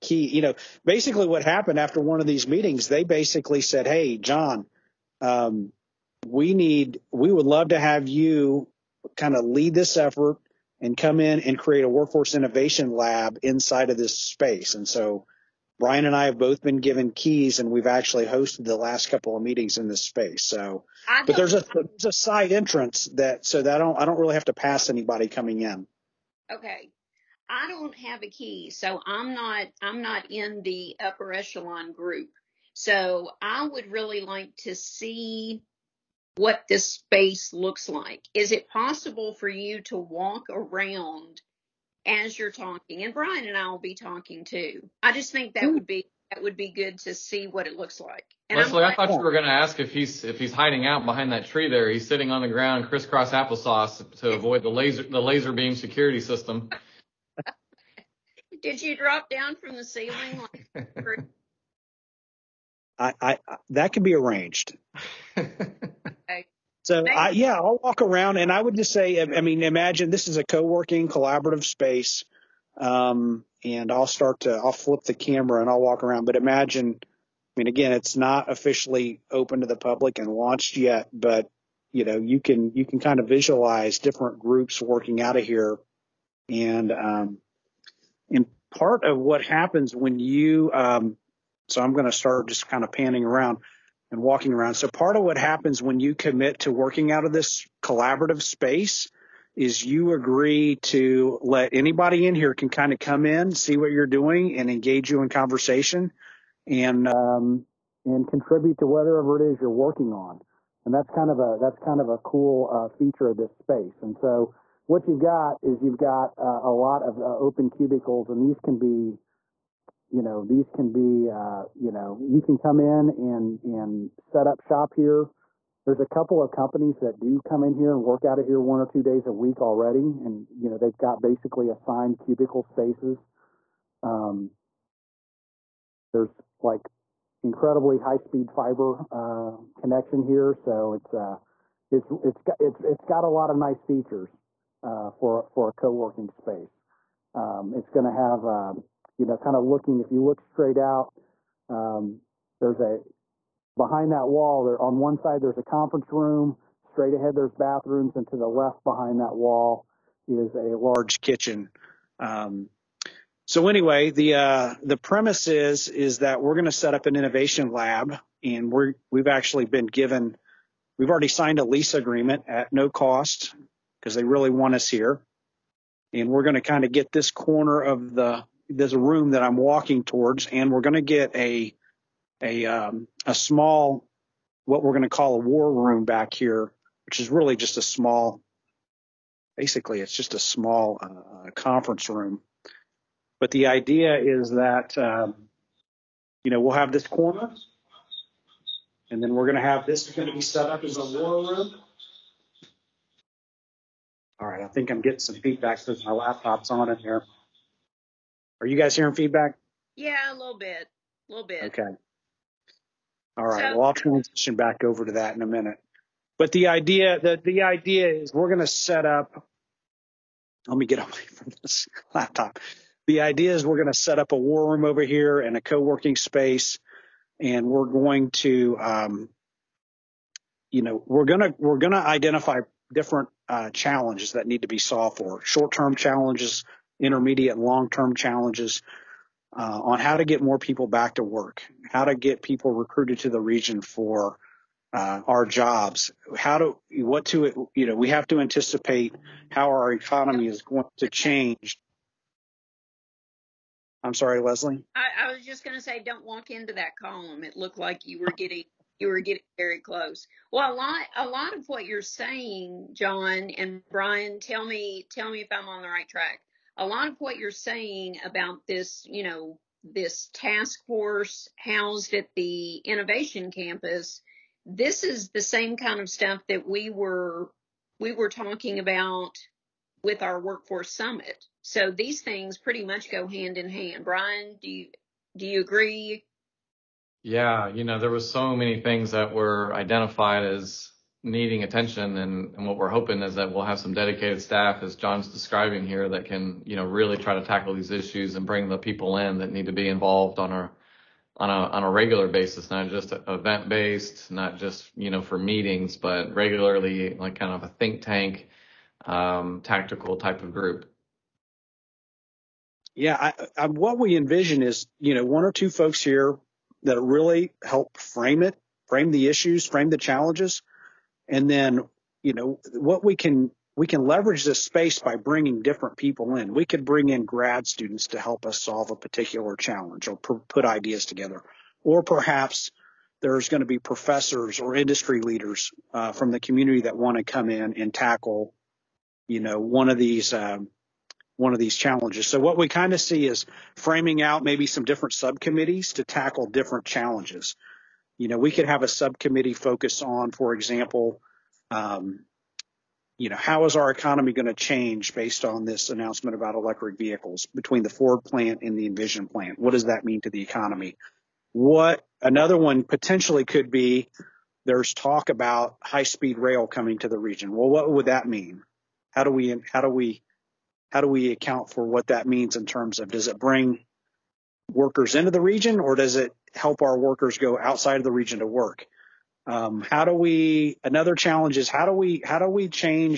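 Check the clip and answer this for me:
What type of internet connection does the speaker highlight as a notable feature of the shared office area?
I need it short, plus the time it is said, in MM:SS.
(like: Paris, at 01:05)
high speed fiber, at 02:17.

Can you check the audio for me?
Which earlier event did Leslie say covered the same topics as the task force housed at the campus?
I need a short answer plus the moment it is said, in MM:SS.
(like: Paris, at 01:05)
workforce summit, at 04:40.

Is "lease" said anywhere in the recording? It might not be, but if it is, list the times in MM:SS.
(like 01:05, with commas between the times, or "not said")
02:51.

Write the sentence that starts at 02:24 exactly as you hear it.
Uh, for for a co-working space.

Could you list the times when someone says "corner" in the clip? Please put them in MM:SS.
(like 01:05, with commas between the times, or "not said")
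02:57, 03:17.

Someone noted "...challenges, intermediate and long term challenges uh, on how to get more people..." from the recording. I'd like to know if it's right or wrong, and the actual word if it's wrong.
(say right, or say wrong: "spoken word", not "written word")
right.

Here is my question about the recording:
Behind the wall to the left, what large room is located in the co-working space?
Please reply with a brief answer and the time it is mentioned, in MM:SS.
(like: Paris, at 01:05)
kitchen, at 02:41.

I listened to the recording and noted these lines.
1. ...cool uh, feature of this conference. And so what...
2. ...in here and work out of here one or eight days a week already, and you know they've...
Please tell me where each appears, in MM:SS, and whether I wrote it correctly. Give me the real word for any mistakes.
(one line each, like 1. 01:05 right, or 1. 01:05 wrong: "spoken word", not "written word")
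1. 01:52 wrong: "space", not "conference"
2. 02:07 wrong: "two", not "eight".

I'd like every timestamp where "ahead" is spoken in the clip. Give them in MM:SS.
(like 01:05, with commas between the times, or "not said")
02:37.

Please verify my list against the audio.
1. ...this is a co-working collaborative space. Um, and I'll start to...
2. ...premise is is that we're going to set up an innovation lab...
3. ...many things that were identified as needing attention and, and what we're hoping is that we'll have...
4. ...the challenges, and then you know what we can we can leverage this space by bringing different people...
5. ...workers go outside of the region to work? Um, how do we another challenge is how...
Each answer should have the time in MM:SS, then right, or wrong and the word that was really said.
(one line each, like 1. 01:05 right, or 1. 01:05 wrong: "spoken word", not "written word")
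1. 01:10 right
2. 02:44 right
3. 04:48 right
4. 05:19 right
5. 06:16 right.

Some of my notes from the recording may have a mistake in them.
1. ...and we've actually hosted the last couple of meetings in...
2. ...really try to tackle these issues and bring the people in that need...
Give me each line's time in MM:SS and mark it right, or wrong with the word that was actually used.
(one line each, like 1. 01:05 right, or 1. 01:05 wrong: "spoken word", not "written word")
1. 00:17 right
2. 04:56 right.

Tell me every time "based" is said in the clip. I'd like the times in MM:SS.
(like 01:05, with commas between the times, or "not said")
05:03, 05:55.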